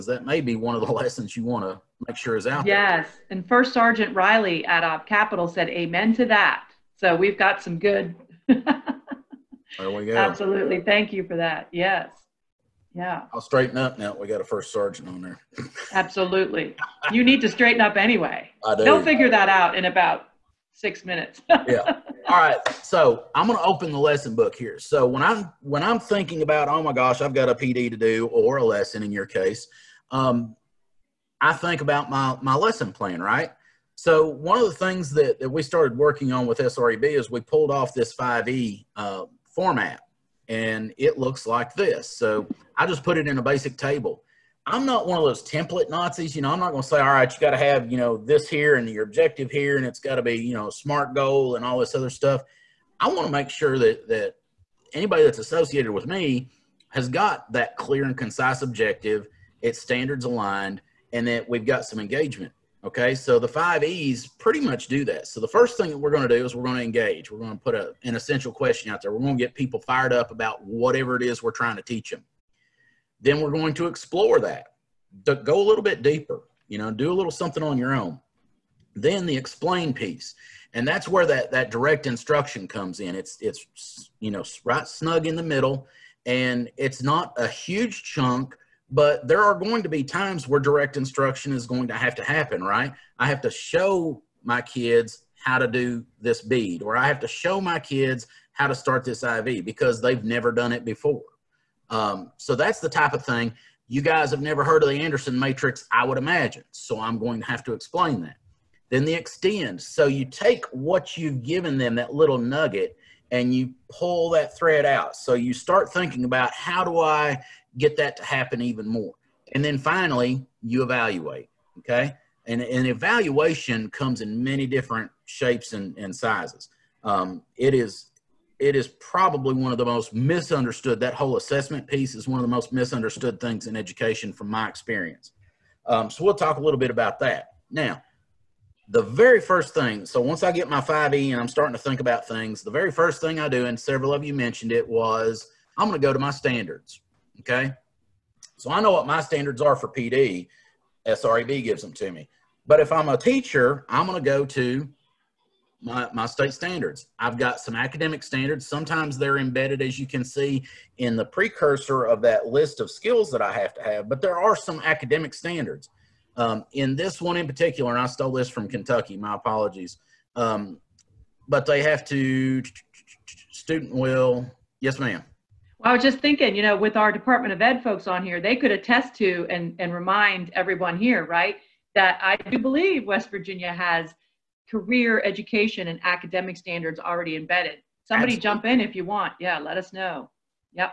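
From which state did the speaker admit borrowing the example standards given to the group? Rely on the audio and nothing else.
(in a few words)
Kentucky.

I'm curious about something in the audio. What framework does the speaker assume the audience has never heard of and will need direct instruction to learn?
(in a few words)
Anderson matrix.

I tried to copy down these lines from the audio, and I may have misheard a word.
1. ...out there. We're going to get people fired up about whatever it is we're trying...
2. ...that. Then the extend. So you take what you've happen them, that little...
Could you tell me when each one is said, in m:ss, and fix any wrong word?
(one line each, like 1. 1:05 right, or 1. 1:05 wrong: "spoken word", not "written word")
1. 1:08 right
2. 1:48 wrong: "given", not "happen".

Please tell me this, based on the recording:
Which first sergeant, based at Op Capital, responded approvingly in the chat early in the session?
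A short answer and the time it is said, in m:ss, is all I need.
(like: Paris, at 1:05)
Riley, at 0:03.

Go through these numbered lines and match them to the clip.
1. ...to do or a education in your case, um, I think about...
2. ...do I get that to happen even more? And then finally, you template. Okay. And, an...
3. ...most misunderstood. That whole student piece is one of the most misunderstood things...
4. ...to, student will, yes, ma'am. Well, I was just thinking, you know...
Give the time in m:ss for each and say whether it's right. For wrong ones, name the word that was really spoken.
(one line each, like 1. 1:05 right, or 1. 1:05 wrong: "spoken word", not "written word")
1. 0:27 wrong: "lesson", not "education"
2. 1:56 wrong: "evaluate", not "template"
3. 2:09 wrong: "assessment", not "student"
4. 2:52 right.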